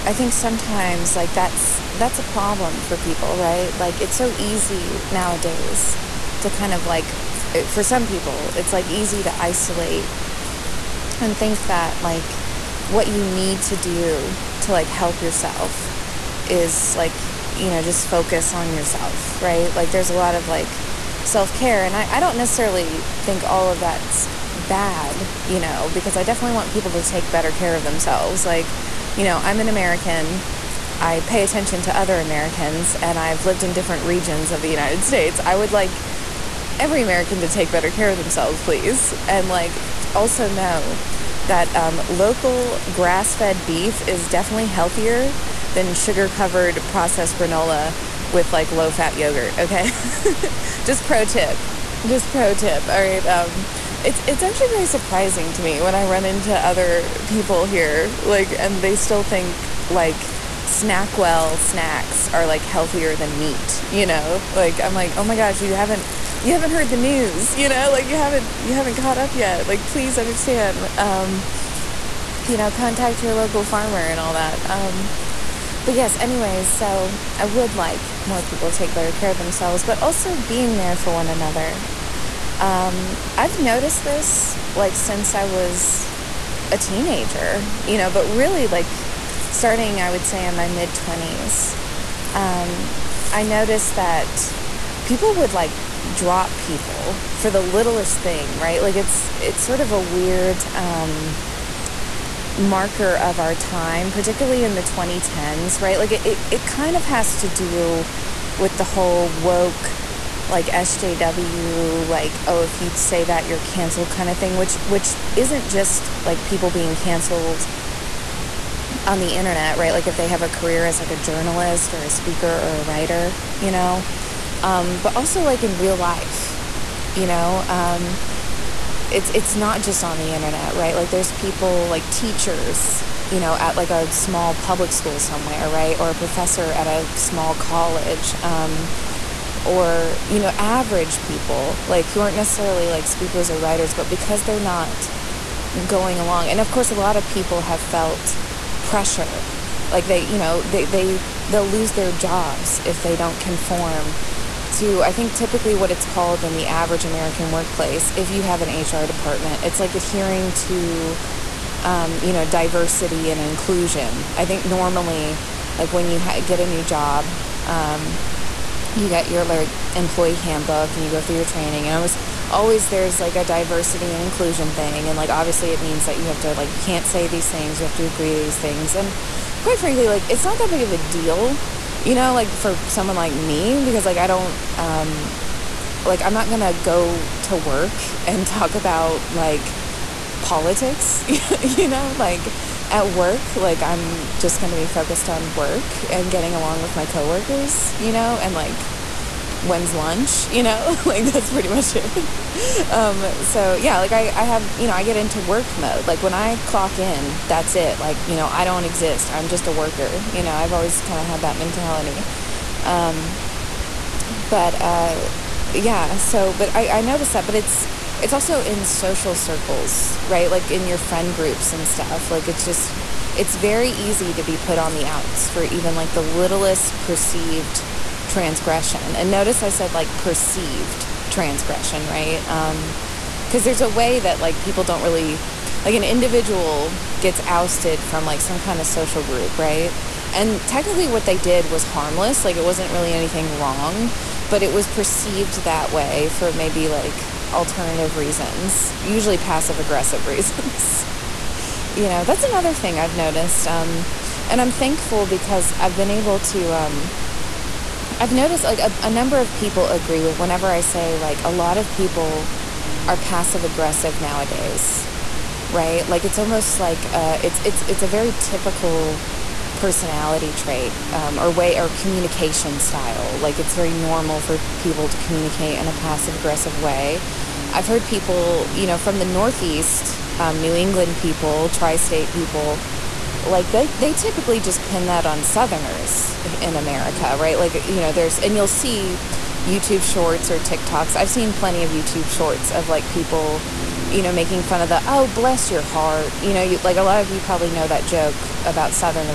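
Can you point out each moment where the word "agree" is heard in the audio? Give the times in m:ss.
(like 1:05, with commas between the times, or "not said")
2:58, 4:19.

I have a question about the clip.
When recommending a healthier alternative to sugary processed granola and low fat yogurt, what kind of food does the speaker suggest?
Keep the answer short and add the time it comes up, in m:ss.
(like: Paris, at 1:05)
local grass fed beef, at 0:42.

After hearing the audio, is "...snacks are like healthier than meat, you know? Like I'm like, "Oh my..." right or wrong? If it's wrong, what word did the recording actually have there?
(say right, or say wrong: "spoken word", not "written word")
right.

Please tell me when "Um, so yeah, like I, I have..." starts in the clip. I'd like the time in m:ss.
3:22.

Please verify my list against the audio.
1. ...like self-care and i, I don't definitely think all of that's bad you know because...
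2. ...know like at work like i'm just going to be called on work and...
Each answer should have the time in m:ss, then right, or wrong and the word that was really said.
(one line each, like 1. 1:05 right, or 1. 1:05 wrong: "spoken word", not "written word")
1. 0:20 wrong: "necessarily", not "definitely"
2. 3:11 wrong: "focused", not "called".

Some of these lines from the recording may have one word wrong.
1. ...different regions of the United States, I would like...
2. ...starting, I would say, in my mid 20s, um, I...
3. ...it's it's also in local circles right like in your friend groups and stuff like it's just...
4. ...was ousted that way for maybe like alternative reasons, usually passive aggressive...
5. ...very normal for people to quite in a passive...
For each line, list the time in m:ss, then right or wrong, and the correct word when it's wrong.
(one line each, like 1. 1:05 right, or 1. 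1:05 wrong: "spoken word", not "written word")
1. 0:33 right
2. 1:29 right
3. 3:37 wrong: "social", not "local"
4. 4:04 wrong: "perceived", not "ousted"
5. 4:33 wrong: "communicate", not "quite".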